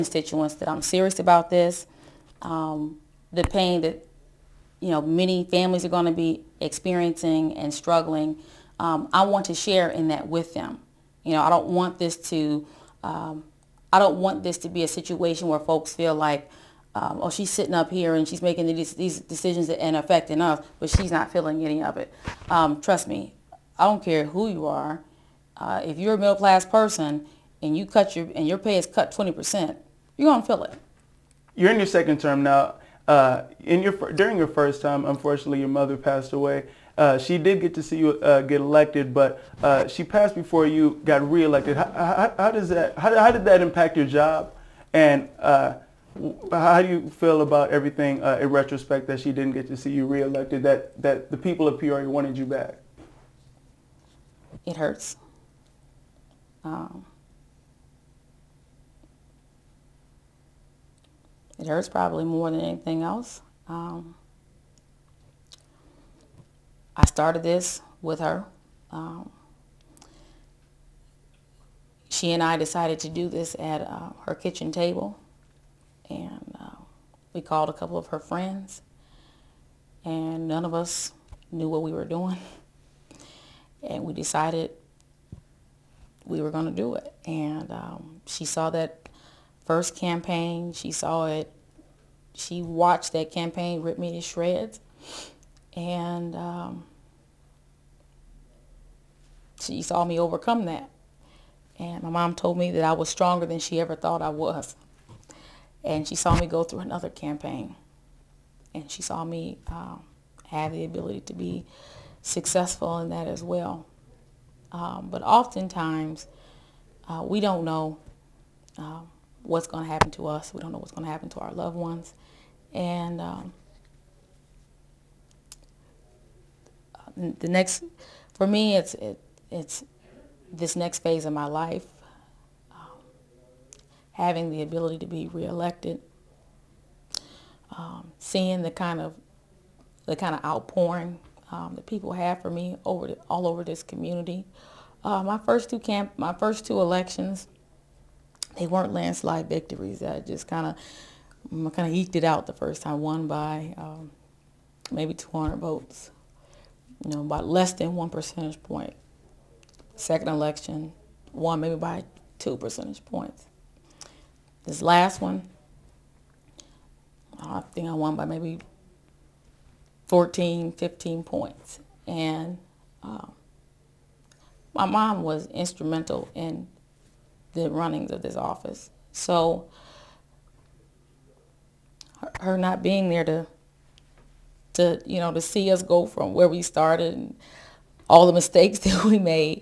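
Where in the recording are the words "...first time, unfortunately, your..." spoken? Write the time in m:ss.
0:34.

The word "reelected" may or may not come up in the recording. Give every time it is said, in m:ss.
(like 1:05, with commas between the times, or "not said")
0:41, 0:50, 2:15.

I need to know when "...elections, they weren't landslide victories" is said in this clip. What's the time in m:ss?
2:26.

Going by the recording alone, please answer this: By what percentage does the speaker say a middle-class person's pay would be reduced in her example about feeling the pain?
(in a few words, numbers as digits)
20%.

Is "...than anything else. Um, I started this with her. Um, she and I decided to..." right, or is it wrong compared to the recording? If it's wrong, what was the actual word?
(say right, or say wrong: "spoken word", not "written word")
right.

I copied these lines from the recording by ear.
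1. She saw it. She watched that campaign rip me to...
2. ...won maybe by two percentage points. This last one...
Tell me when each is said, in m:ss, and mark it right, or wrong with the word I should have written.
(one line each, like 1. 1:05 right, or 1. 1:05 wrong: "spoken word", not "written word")
1. 1:30 right
2. 2:41 right.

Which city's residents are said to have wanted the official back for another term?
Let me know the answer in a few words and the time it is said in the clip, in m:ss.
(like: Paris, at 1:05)
Peoria, at 0:51.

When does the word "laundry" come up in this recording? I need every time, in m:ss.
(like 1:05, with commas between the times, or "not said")
not said.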